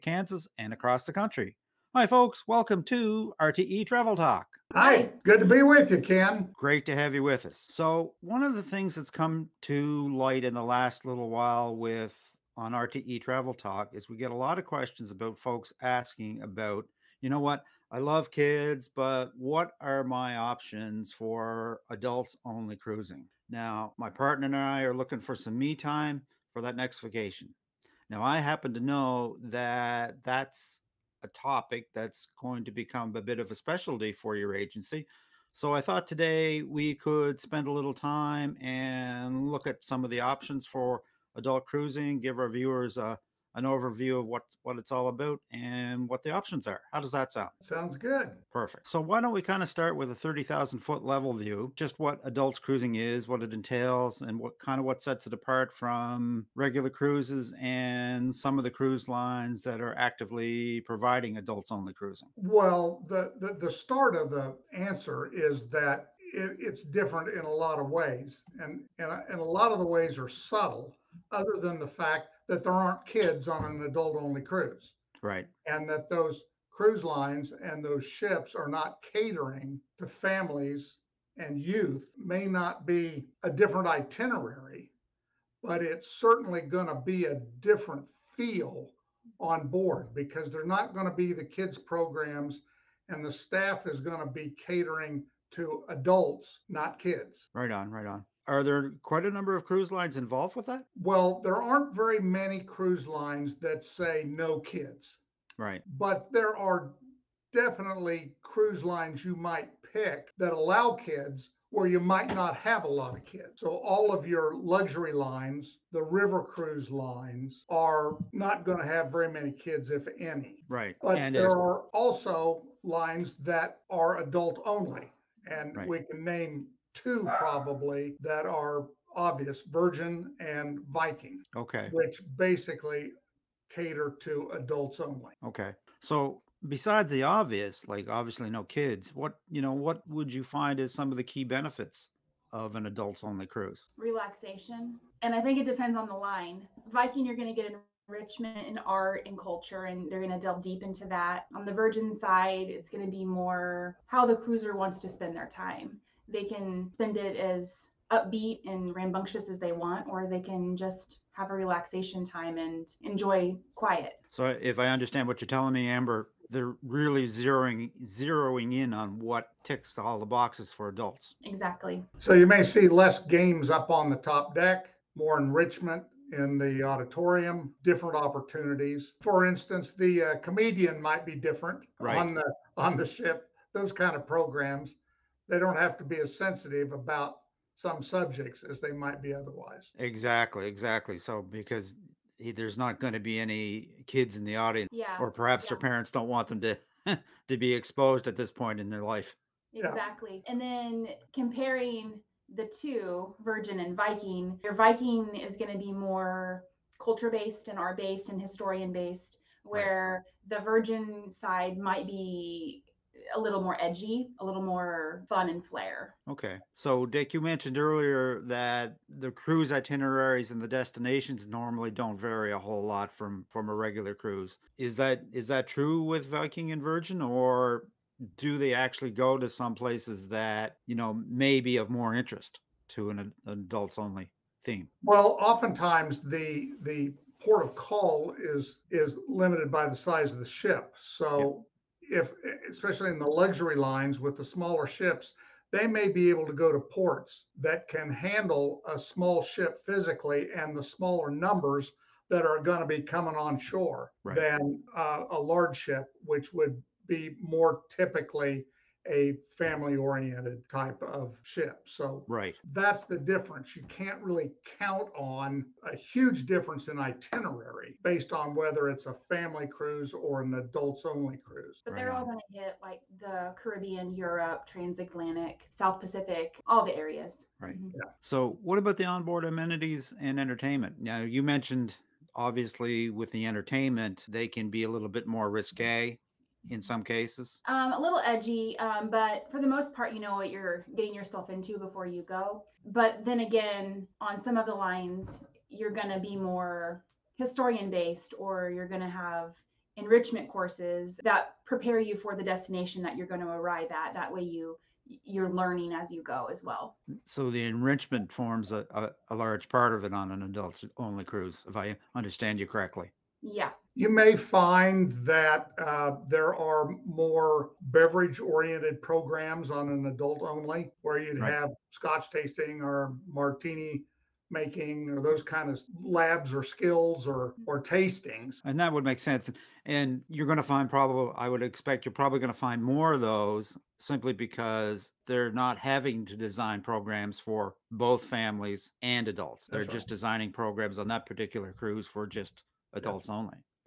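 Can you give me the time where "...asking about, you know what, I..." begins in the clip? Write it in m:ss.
0:15.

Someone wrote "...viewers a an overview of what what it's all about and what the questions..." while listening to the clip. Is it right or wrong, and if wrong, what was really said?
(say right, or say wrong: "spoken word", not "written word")
wrong: "options", not "questions".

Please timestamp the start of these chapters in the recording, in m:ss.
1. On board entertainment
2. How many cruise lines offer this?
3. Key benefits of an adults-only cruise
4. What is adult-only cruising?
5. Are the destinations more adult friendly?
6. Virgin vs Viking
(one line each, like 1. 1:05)
1. 4:48
2. 1:39
3. 2:20
4. 0:54
5. 3:55
6. 3:25.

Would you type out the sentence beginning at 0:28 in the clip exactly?
Now, I happen to know that that's a topic that's going to become a bit of a specialty for your agency.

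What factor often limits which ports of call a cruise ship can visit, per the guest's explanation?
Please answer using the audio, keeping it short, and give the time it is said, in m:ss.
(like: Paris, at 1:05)
size of the ship, at 3:59.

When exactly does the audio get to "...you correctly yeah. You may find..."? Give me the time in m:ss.
5:12.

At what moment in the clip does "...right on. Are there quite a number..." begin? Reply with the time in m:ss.
1:37.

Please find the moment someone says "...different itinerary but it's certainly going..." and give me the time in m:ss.
1:23.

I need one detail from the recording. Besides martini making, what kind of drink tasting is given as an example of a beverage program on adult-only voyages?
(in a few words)
scotch tasting.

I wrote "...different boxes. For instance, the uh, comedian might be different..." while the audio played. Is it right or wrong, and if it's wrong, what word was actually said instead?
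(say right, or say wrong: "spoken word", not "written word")
wrong: "opportunities", not "boxes".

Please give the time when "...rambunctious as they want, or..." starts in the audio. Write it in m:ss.
2:38.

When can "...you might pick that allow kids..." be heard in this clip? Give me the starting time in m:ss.
1:49.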